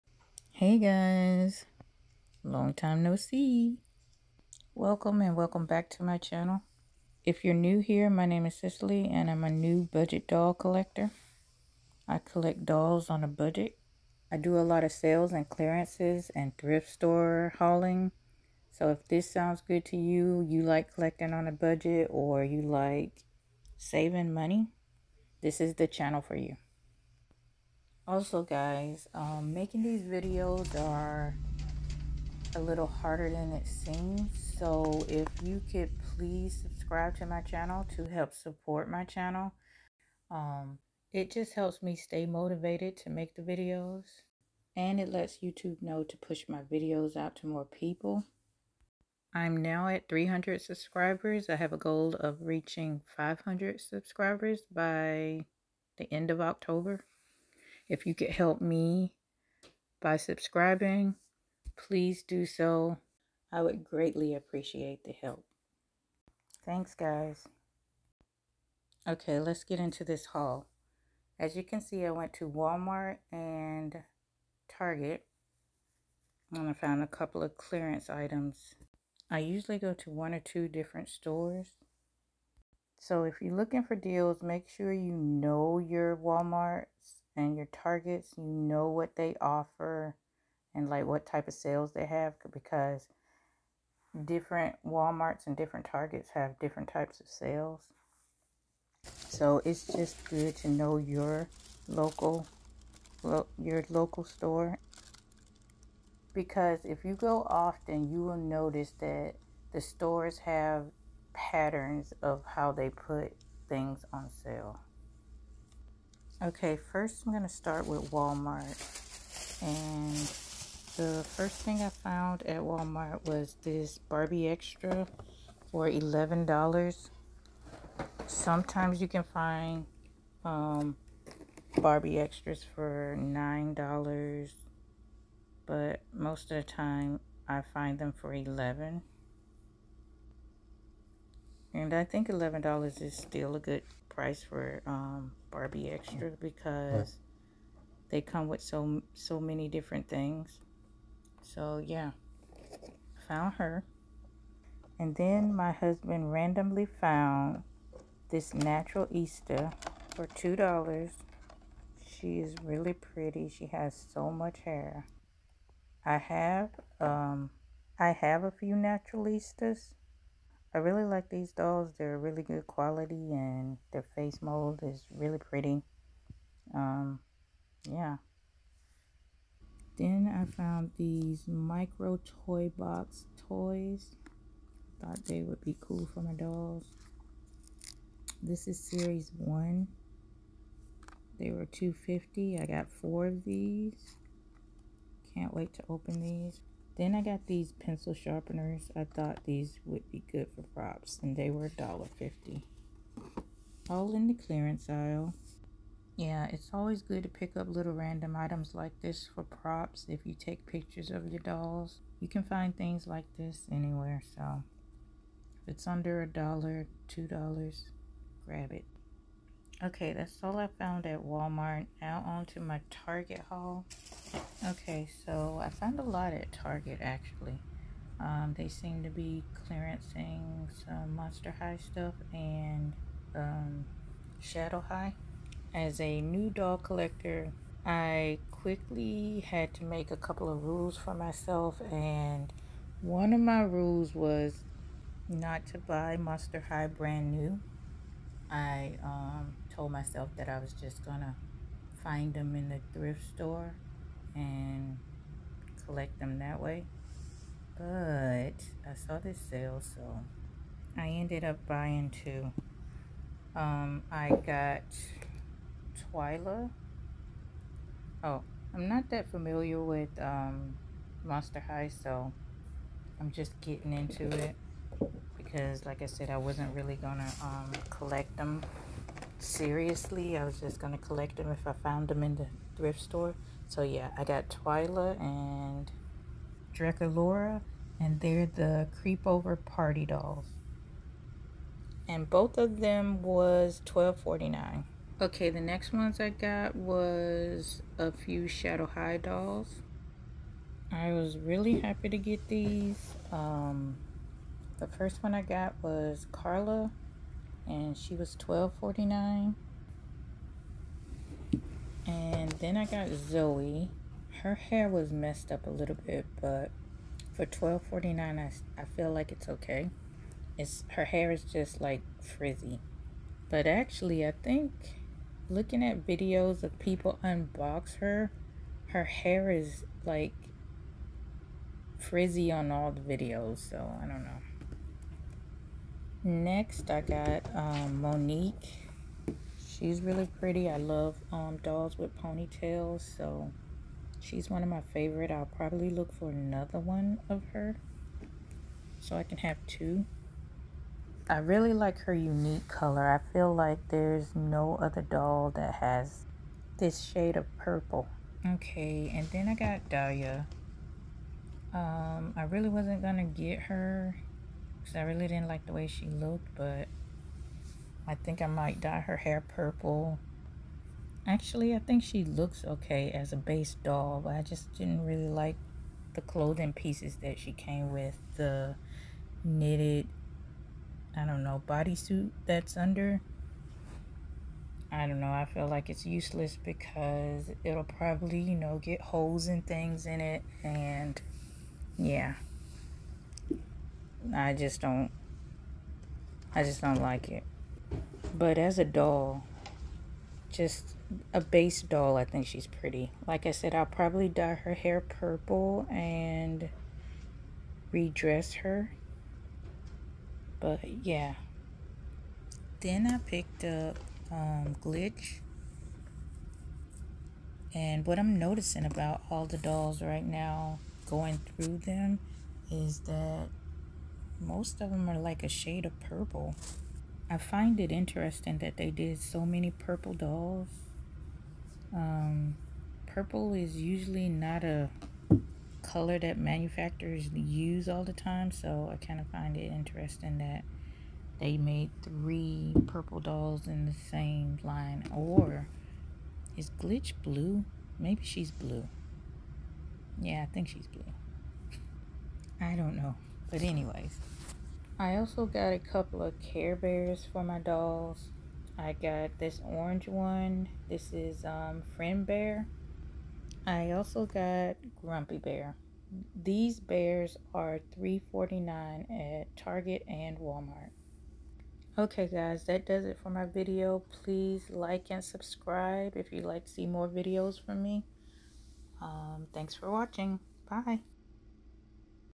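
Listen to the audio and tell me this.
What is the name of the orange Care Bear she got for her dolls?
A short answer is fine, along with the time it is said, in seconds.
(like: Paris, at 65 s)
Friend Bear, at 461 s.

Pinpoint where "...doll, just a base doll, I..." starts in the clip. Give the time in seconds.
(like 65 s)
398 s.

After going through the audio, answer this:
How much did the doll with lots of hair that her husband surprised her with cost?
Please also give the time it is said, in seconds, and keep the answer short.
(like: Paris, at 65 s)
$2, at 160 s.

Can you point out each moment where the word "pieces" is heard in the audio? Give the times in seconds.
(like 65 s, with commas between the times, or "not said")
376 s.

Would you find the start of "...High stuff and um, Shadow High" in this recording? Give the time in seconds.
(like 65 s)
231 s.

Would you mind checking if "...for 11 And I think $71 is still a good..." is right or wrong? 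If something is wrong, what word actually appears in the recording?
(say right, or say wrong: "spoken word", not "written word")
wrong: "11", not "71".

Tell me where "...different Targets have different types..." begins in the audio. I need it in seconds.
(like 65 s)
95 s.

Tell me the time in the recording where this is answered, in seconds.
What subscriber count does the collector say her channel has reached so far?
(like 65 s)
50 s.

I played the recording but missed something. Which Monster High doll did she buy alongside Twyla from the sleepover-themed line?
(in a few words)
Draculaura.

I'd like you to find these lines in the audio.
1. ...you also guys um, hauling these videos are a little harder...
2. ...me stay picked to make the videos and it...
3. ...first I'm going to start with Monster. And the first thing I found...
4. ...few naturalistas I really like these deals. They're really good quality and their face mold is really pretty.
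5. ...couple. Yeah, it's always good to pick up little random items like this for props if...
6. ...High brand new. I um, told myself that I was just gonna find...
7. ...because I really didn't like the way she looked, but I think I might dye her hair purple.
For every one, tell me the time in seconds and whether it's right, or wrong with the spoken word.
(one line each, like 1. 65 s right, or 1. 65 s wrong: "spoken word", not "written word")
1. 26 s wrong: "making", not "hauling"
2. 41 s wrong: "motivated", not "picked"
3. 116 s wrong: "Walmart", not "Monster"
4. 168 s wrong: "dolls", not "deals"
5. 204 s wrong: "aisle", not "couple"
6. 246 s right
7. 364 s right.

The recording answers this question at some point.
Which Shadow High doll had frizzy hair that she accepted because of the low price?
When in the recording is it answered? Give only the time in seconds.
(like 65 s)
313 s.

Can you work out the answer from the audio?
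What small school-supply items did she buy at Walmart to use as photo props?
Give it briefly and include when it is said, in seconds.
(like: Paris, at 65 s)
Pencil sharpeners, at 197 s.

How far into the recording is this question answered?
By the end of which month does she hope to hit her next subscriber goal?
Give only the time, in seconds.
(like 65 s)
56 s.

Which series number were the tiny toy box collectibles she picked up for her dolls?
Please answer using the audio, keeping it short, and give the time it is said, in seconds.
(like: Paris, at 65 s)
Series one, at 188 s.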